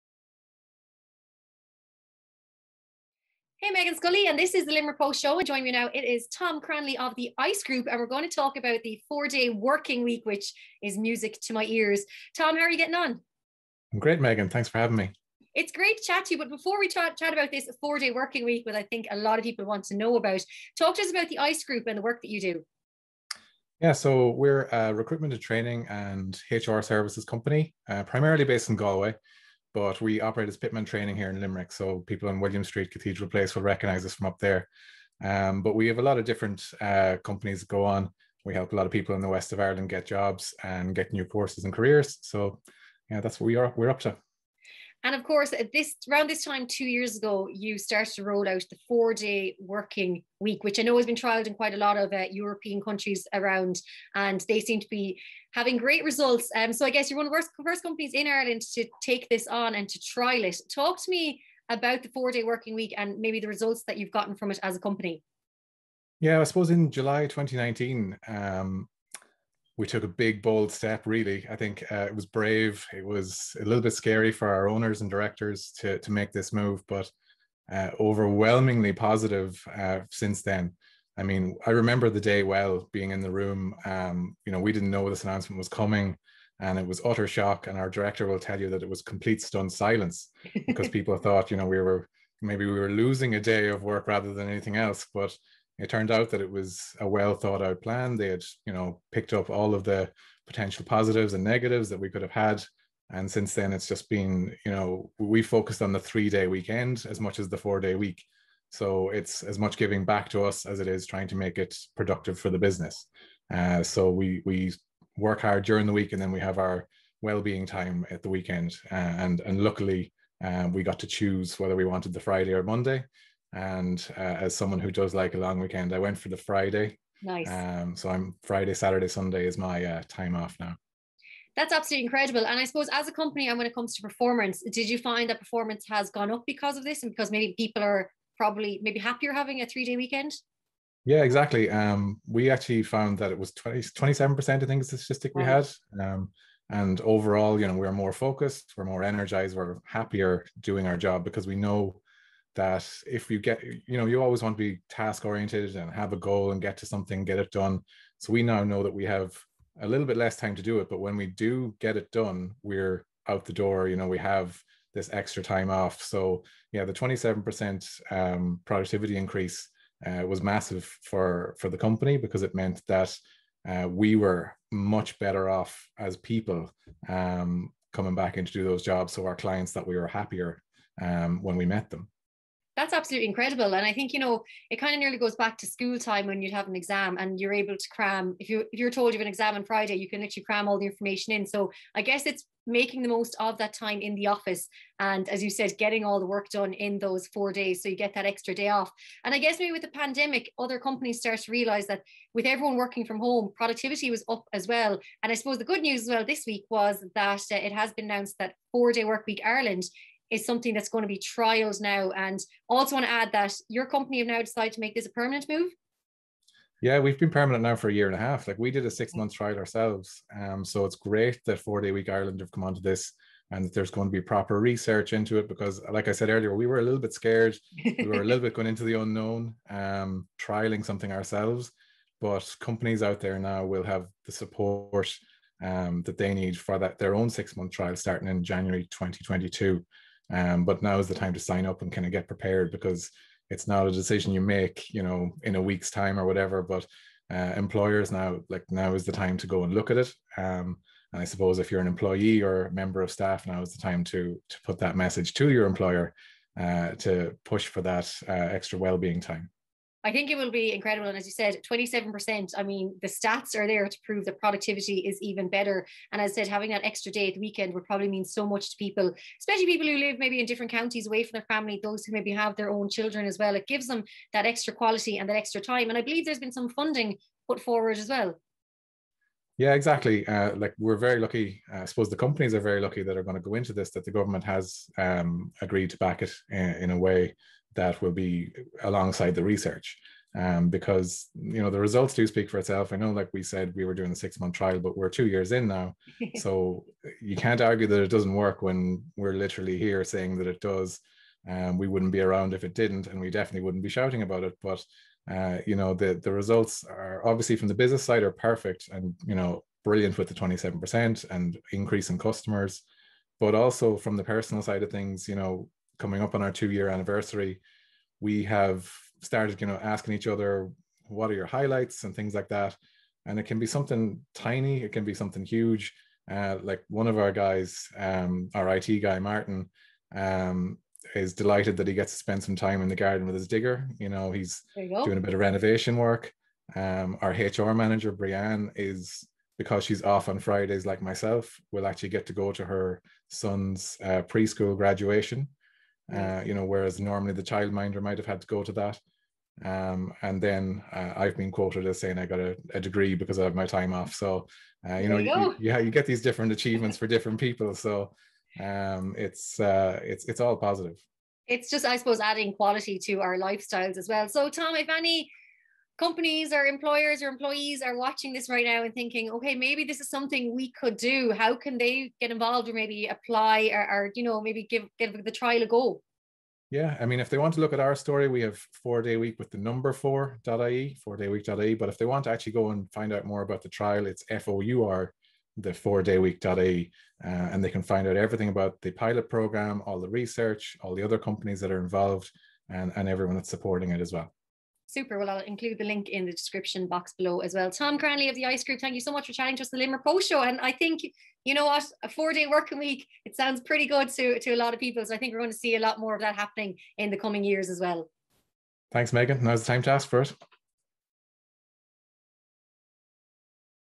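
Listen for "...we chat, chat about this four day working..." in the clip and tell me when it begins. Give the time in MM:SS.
00:16.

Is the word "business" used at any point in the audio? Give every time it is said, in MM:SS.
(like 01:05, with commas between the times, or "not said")
01:52, 05:07.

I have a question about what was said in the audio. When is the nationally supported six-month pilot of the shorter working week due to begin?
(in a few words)
January 2022.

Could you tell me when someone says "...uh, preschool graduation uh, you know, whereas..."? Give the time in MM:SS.
05:44.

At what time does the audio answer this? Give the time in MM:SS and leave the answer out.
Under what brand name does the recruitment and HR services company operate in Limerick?
00:30.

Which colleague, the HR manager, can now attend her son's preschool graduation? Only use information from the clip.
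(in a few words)
Brianne.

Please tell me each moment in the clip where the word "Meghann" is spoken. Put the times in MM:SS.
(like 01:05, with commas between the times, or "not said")
00:03, 00:14, 06:49.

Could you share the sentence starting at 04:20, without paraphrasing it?
I think it will be incredible.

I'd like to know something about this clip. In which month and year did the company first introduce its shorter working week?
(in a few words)
July 2019.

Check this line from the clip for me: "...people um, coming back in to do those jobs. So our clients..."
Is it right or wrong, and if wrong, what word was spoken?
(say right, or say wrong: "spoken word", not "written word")
right.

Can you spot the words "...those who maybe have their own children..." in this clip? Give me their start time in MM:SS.
04:31.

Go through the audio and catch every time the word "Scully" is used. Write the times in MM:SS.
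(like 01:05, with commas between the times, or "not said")
00:03.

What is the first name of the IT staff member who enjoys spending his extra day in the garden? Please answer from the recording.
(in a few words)
Martin.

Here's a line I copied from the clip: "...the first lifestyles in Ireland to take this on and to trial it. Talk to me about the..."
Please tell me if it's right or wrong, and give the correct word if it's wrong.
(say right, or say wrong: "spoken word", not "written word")
wrong: "companies", not "lifestyles".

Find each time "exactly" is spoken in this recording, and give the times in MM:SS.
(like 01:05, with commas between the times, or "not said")
02:21, 04:39.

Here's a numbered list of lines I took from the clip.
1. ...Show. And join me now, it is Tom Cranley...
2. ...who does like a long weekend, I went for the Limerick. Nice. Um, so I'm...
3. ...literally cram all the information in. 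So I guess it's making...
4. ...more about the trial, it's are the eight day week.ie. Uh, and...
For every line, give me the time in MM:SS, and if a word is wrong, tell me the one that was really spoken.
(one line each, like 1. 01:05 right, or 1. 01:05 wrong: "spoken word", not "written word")
1. 00:05 right
2. 02:04 wrong: "Friday", not "Limerick"
3. 03:10 right
4. 06:23 wrong: "four", not "eight".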